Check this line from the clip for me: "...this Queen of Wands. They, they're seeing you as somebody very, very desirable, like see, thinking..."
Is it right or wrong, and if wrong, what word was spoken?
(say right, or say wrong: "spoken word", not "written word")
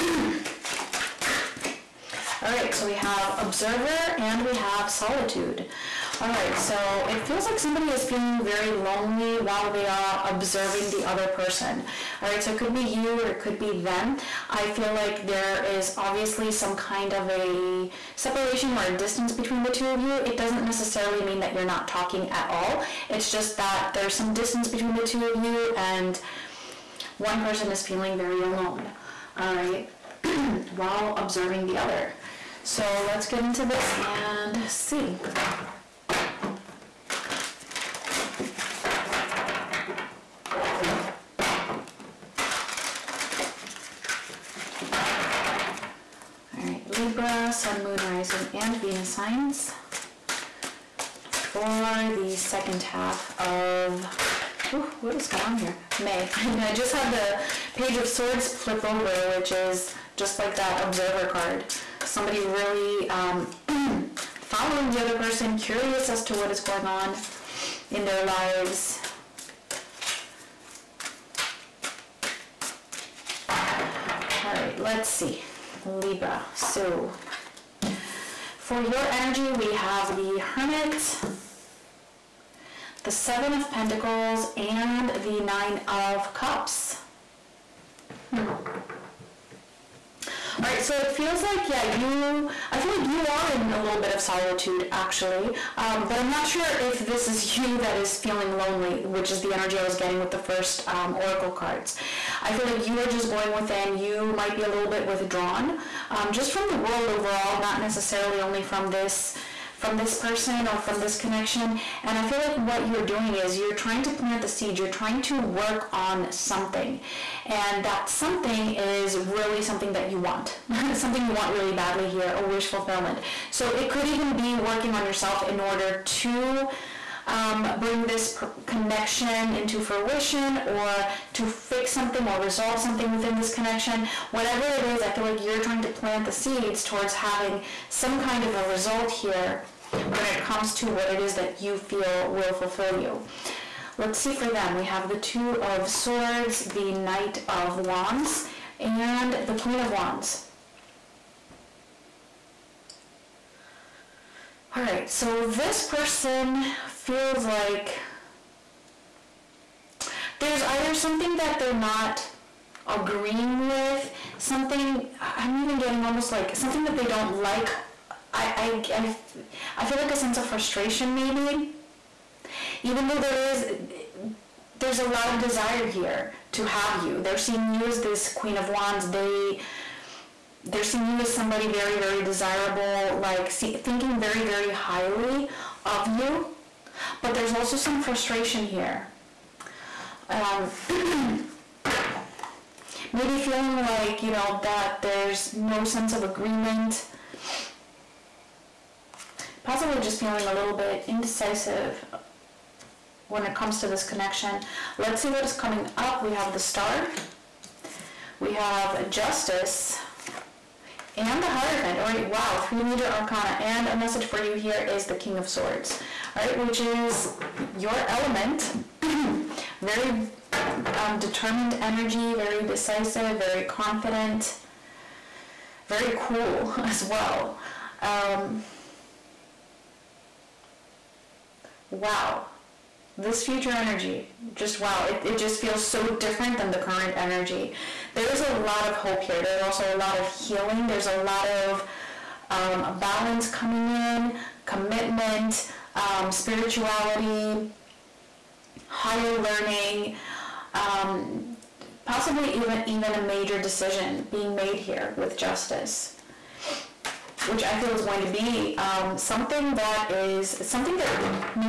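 right.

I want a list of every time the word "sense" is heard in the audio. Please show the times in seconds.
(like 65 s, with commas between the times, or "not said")
170 s, 195 s.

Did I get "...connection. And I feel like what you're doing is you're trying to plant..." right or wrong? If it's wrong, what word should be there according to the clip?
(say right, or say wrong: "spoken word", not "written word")
right.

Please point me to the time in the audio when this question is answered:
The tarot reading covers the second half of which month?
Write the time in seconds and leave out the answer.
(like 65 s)
56 s.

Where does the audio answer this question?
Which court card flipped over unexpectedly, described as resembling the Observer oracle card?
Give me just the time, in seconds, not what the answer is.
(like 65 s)
57 s.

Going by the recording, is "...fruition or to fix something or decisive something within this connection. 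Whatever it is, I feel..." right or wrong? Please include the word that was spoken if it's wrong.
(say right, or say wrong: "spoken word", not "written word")
wrong: "resolve", not "decisive".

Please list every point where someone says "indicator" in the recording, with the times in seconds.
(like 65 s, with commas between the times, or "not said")
not said.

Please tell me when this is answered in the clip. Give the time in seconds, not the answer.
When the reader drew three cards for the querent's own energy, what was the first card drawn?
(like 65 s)
80 s.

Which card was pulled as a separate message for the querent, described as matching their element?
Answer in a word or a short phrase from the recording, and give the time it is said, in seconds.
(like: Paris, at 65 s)
King of Swords, at 215 s.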